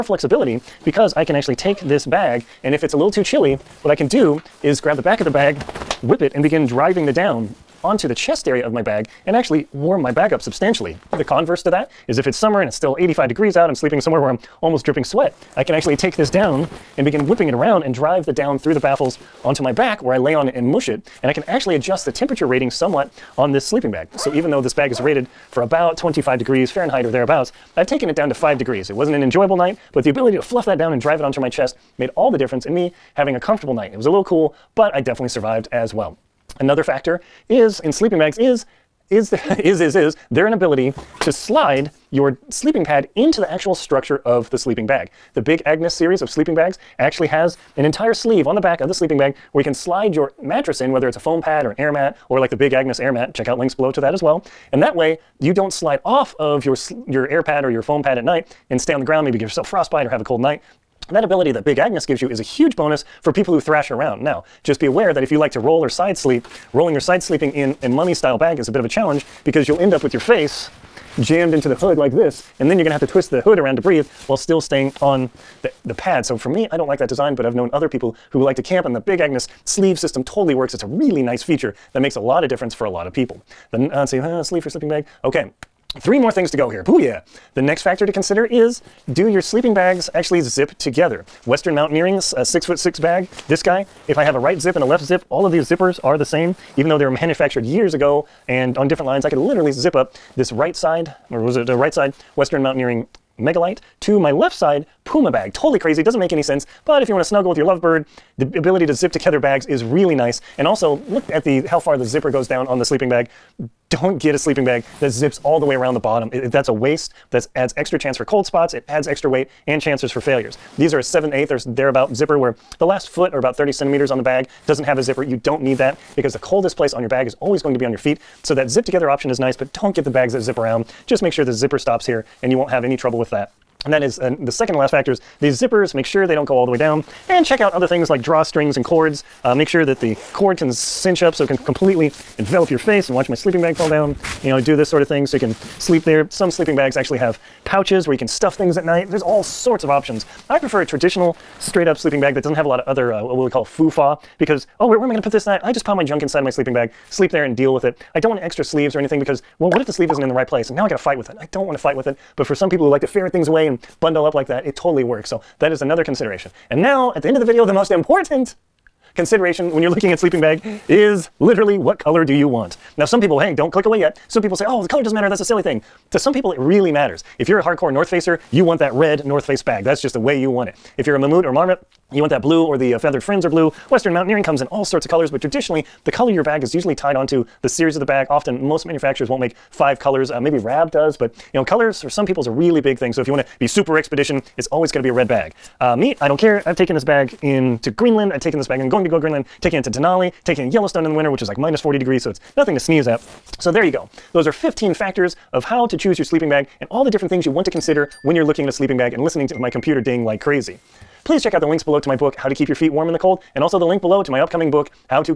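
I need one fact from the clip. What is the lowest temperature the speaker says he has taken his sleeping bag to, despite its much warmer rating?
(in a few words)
5 degrees.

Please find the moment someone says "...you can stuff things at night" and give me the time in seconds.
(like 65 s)
148 s.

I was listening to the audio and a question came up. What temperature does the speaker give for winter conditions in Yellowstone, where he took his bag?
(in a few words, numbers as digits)
-40 degrees.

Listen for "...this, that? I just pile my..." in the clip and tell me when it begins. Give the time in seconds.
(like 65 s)
155 s.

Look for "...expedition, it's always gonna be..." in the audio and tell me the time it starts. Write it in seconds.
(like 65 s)
193 s.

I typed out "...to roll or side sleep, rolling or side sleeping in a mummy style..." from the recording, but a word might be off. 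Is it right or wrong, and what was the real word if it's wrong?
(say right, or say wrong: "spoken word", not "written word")
right.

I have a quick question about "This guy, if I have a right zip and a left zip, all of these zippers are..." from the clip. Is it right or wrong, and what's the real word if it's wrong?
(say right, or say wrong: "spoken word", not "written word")
right.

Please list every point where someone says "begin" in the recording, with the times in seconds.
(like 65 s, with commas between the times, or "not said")
6 s, 17 s.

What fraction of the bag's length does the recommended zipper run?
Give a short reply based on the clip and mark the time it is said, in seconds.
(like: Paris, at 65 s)
7/8, at 121 s.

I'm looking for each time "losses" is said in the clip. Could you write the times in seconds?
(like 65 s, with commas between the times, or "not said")
not said.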